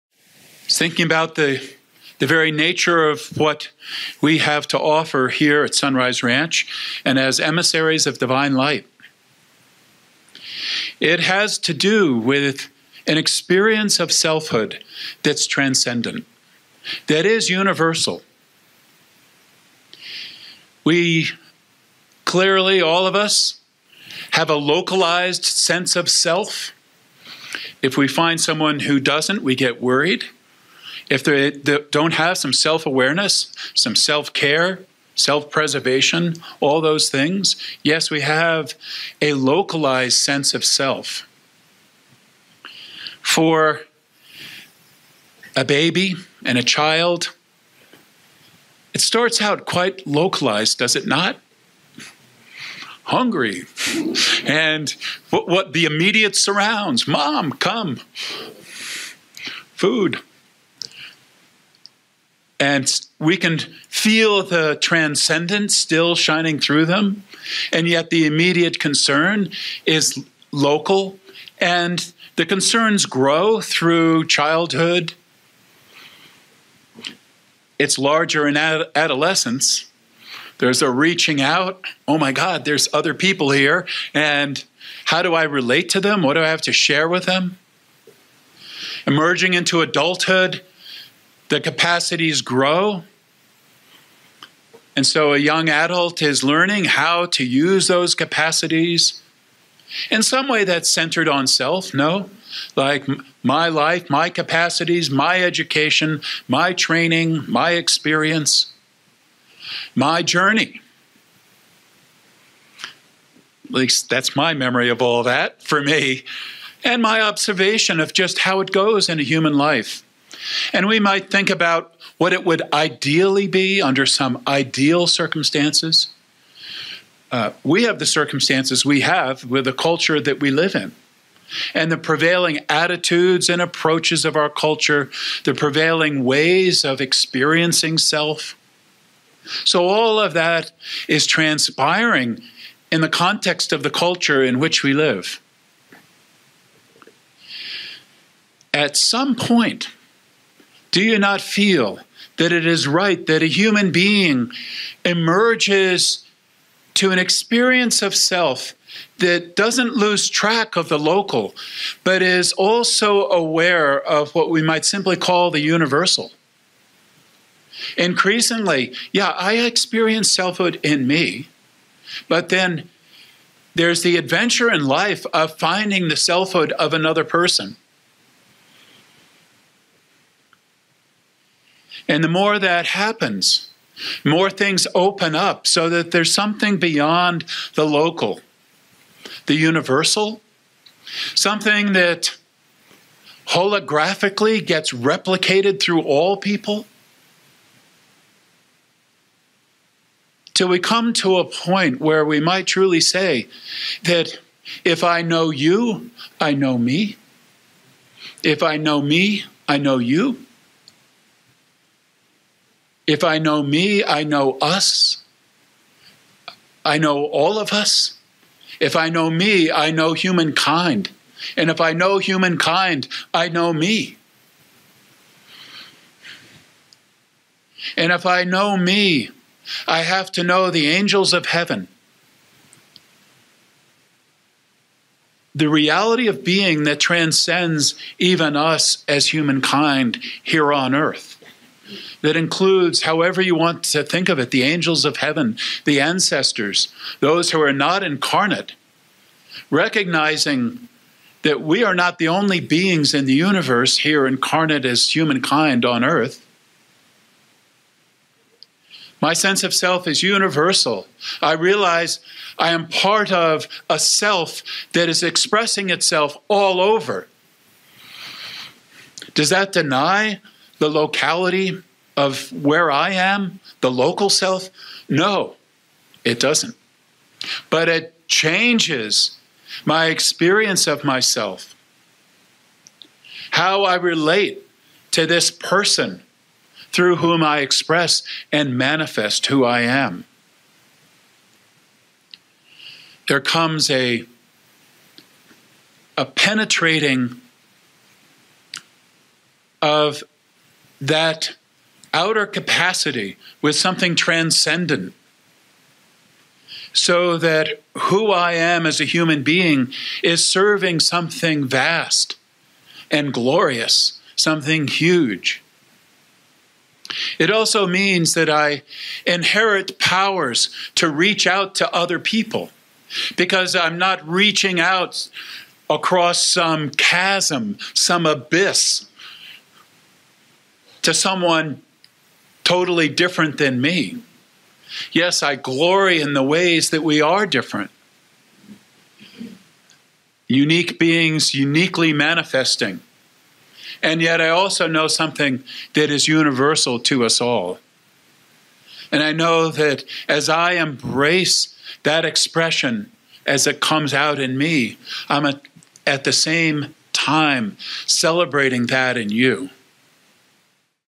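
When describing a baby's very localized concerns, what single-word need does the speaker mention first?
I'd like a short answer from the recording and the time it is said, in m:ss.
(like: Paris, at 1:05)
Hungry, at 0:53.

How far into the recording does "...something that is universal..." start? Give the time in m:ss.
5:45.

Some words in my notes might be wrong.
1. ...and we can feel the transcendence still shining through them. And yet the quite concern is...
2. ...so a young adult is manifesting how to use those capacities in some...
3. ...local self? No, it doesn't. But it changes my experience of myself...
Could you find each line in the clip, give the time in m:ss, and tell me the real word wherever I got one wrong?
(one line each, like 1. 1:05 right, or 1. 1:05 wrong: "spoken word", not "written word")
1. 1:02 wrong: "immediate", not "quite"
2. 1:35 wrong: "learning", not "manifesting"
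3. 4:33 right.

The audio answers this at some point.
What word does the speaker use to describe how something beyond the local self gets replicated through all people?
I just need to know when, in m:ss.
3:13.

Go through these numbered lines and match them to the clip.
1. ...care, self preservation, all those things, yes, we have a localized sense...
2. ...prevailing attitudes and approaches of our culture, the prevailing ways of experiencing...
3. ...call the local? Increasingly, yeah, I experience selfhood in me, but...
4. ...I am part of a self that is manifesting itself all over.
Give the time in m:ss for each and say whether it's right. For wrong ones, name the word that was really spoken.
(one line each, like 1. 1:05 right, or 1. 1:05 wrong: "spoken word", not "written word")
1. 0:34 right
2. 2:11 right
3. 2:45 wrong: "universal", not "local"
4. 4:22 wrong: "expressing", not "manifesting".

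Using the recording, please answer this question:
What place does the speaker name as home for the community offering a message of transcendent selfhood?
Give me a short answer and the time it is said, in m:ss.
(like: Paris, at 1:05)
Sunrise Ranch, at 0:05.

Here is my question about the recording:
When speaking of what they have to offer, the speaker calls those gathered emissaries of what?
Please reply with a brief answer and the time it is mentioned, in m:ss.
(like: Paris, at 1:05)
divine light, at 0:08.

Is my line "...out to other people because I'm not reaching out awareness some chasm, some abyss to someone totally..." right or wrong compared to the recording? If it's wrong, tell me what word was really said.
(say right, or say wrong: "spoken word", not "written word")
wrong: "across", not "awareness".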